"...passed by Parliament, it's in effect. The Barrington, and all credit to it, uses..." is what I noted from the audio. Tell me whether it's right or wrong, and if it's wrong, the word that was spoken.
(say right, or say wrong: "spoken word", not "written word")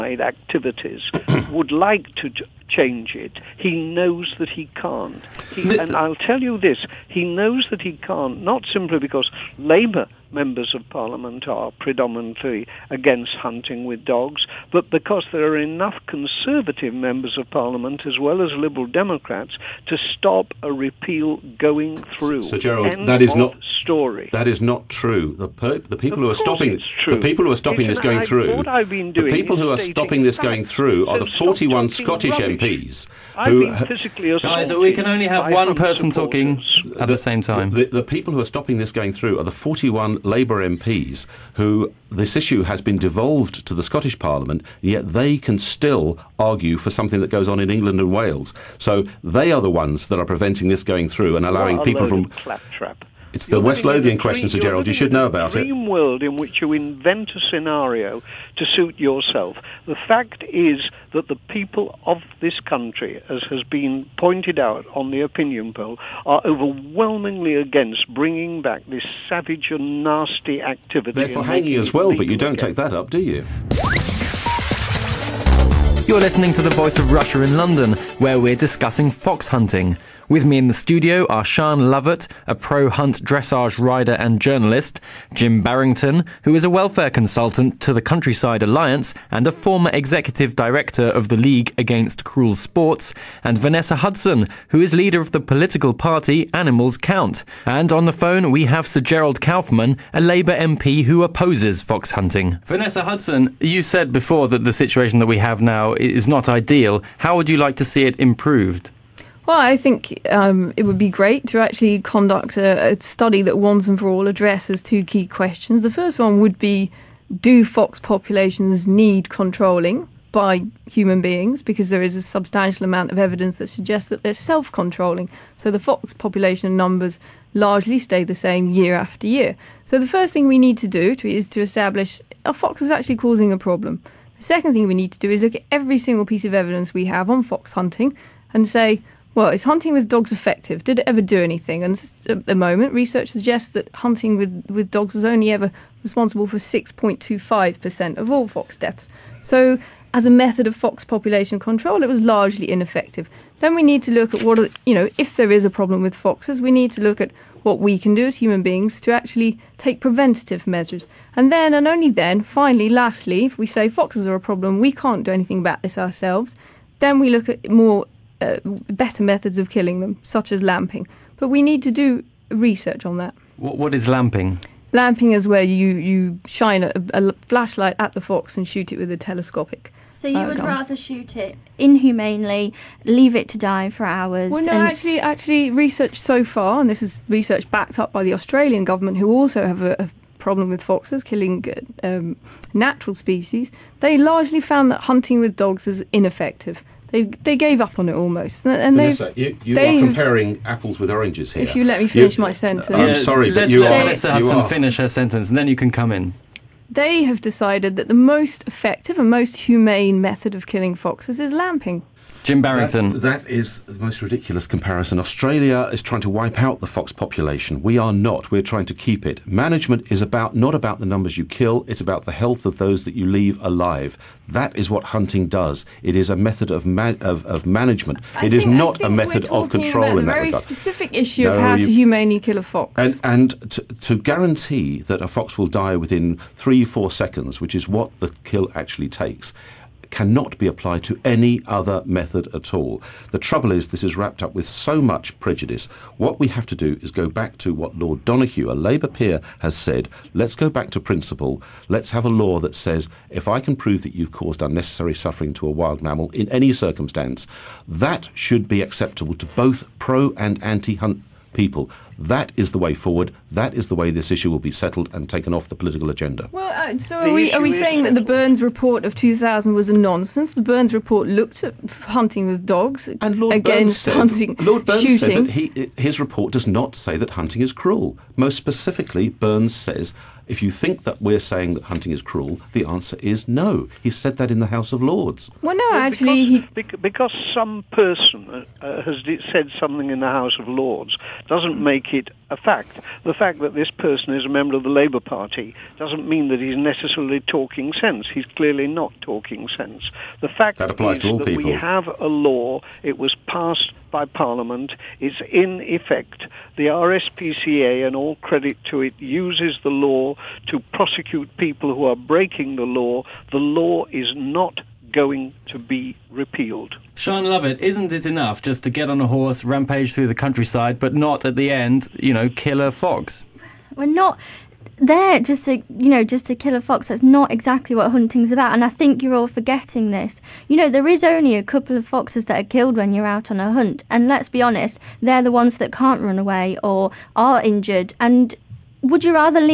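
wrong: "RSPCA", not "Barrington".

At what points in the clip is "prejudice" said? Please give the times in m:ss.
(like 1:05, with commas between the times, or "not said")
4:05.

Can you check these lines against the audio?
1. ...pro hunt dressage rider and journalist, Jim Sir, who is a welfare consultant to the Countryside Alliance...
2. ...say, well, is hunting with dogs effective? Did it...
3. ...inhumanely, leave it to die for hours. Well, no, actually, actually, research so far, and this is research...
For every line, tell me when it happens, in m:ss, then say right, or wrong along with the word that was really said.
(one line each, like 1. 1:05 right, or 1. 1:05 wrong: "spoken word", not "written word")
1. 1:22 wrong: "Barrington", not "Sir"
2. 2:18 right
3. 3:01 right.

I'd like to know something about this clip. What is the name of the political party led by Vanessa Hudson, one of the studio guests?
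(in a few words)
Animals Count.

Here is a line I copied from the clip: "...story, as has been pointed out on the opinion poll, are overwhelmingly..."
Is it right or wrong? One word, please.
wrong.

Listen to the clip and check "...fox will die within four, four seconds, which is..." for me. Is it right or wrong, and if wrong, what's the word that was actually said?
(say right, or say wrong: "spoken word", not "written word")
wrong: "three", not "four".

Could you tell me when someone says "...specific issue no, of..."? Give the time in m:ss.
3:50.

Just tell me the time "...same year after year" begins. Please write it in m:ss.
2:08.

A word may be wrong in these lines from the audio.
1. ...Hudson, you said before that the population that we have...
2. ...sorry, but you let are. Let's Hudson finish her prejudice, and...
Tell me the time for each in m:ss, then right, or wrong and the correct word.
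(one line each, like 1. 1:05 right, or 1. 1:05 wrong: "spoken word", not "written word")
1. 1:43 wrong: "situation", not "population"
2. 3:23 wrong: "sentence", not "prejudice".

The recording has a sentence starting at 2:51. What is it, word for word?
But we need to do research on that.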